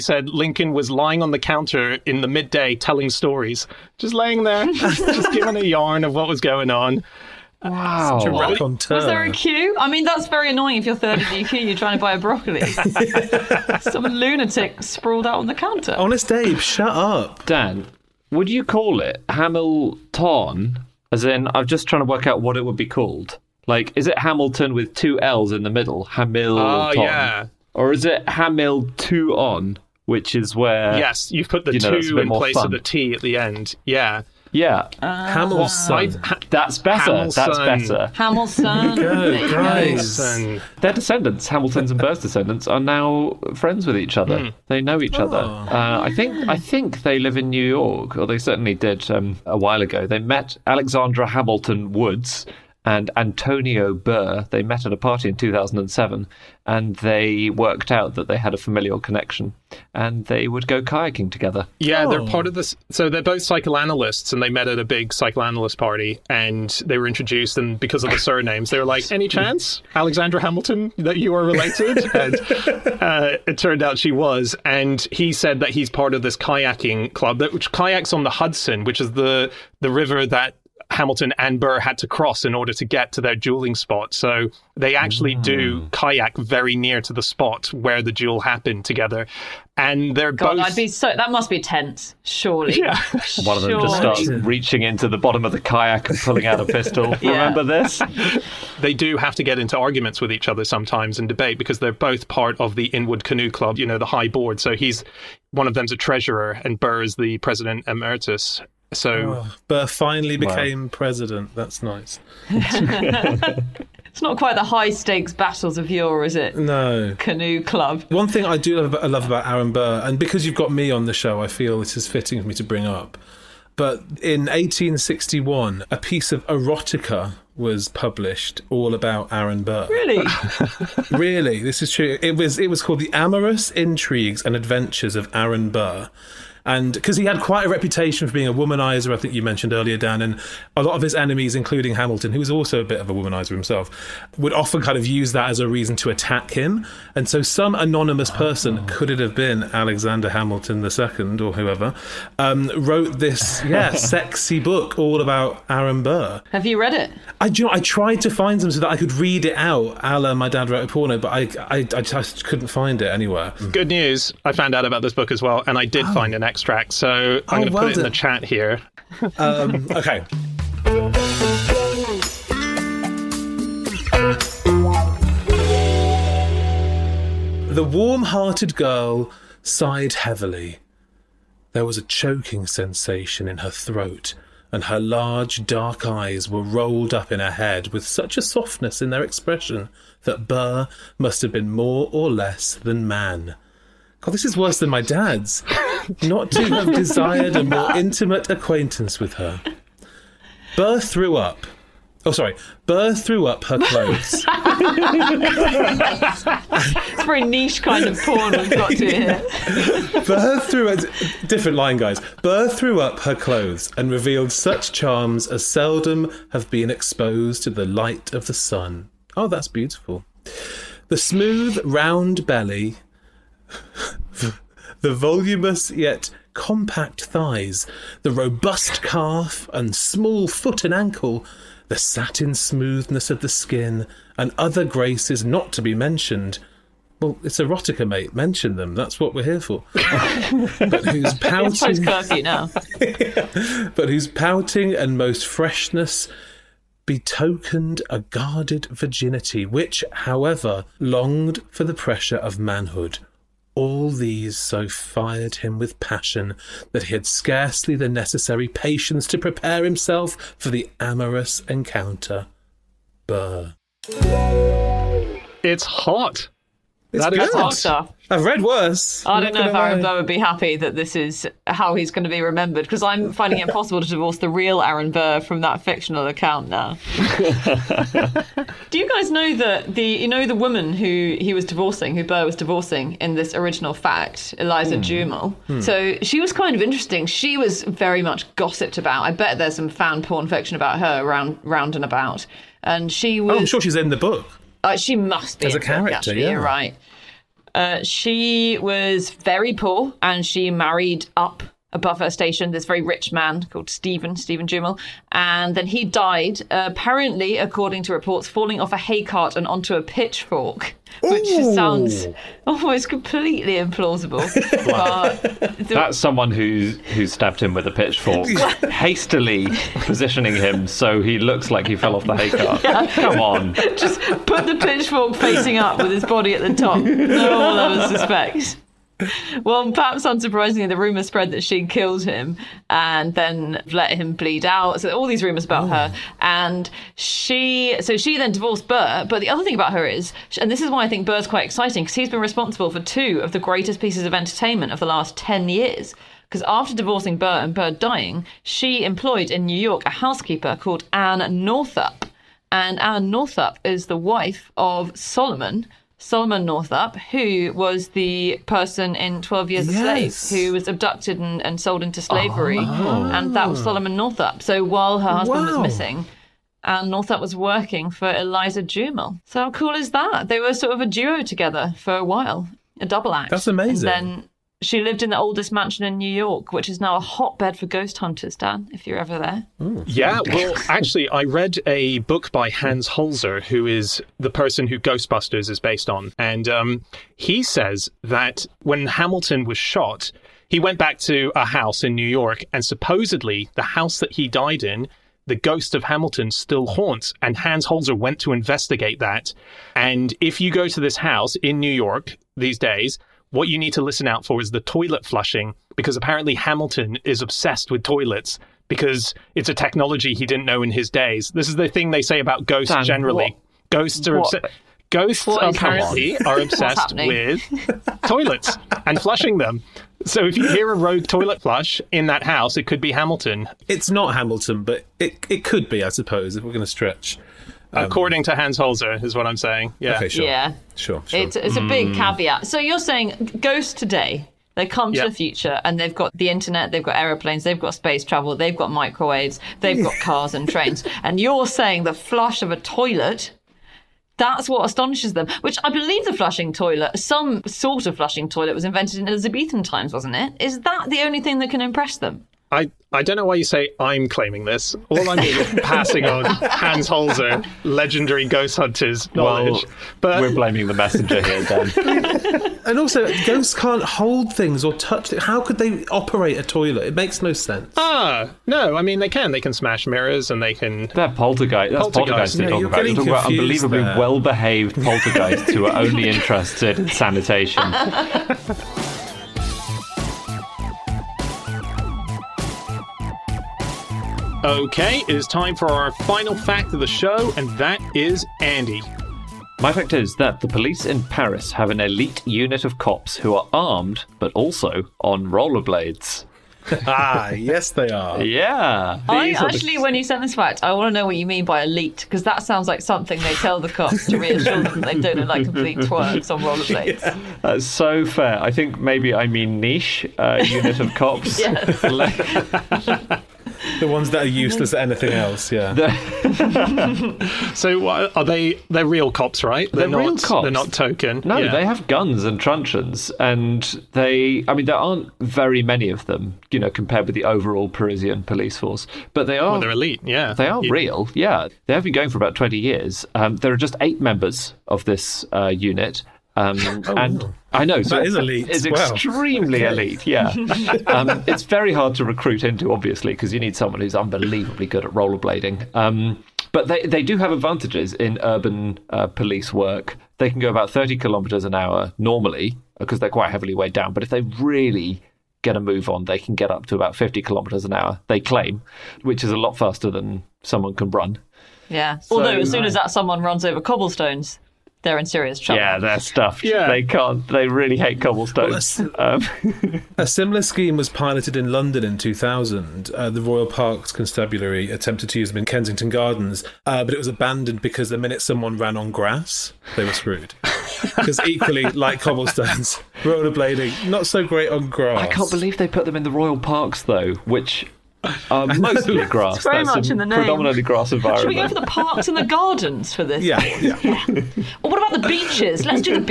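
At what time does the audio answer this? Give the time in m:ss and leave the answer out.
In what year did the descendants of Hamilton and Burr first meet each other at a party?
0:55.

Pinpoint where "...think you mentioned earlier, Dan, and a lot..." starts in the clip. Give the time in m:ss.
2:19.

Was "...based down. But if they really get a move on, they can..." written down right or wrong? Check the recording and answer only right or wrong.
wrong.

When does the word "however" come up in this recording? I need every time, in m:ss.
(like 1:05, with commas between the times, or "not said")
4:10.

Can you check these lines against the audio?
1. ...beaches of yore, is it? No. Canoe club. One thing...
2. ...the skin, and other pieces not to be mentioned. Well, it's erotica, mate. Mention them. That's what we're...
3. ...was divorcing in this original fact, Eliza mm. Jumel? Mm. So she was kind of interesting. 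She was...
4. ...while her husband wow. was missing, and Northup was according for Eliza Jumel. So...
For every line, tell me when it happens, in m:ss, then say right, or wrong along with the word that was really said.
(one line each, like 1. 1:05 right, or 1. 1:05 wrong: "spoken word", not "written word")
1. 1:55 wrong: "battles", not "beaches"
2. 3:53 wrong: "graces", not "pieces"
3. 4:42 right
4. 6:04 wrong: "working", not "according".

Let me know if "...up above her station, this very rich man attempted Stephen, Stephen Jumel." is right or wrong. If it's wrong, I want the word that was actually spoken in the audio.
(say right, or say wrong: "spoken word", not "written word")
wrong: "called", not "attempted".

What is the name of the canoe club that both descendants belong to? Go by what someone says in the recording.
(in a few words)
Inwood Canoe Club.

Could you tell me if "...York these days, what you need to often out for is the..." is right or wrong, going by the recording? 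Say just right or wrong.
wrong.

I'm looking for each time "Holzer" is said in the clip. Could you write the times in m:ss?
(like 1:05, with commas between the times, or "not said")
6:23, 6:37, 7:08, 7:37.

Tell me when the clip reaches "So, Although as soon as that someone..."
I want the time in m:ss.
9:22.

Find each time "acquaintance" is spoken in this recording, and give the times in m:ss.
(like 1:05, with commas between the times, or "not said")
3:18.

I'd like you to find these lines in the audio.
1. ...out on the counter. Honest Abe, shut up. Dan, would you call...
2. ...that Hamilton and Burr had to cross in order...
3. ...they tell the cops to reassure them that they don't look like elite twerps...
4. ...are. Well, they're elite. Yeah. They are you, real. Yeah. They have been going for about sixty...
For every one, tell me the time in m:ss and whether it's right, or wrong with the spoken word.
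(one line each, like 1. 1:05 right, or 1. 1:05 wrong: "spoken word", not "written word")
1. 0:15 right
2. 1:20 right
3. 8:23 wrong: "complete", not "elite"
4. 8:49 wrong: "twenty", not "sixty".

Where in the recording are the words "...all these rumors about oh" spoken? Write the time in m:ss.
5:35.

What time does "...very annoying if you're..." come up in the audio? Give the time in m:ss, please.
0:10.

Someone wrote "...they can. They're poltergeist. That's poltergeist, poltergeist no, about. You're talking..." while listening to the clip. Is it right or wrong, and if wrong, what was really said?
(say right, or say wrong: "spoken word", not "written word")
right.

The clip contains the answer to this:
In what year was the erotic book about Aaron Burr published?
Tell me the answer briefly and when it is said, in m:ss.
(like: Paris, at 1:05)
1861, at 2:04.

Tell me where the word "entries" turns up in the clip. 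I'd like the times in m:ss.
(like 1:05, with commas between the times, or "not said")
not said.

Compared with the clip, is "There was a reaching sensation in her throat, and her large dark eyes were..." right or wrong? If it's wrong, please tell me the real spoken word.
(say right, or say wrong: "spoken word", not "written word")
wrong: "choking", not "reaching".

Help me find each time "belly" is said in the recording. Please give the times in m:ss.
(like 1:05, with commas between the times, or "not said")
3:42.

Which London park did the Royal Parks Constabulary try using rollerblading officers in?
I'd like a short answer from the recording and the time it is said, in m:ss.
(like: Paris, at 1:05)
Kensington Gardens, at 9:35.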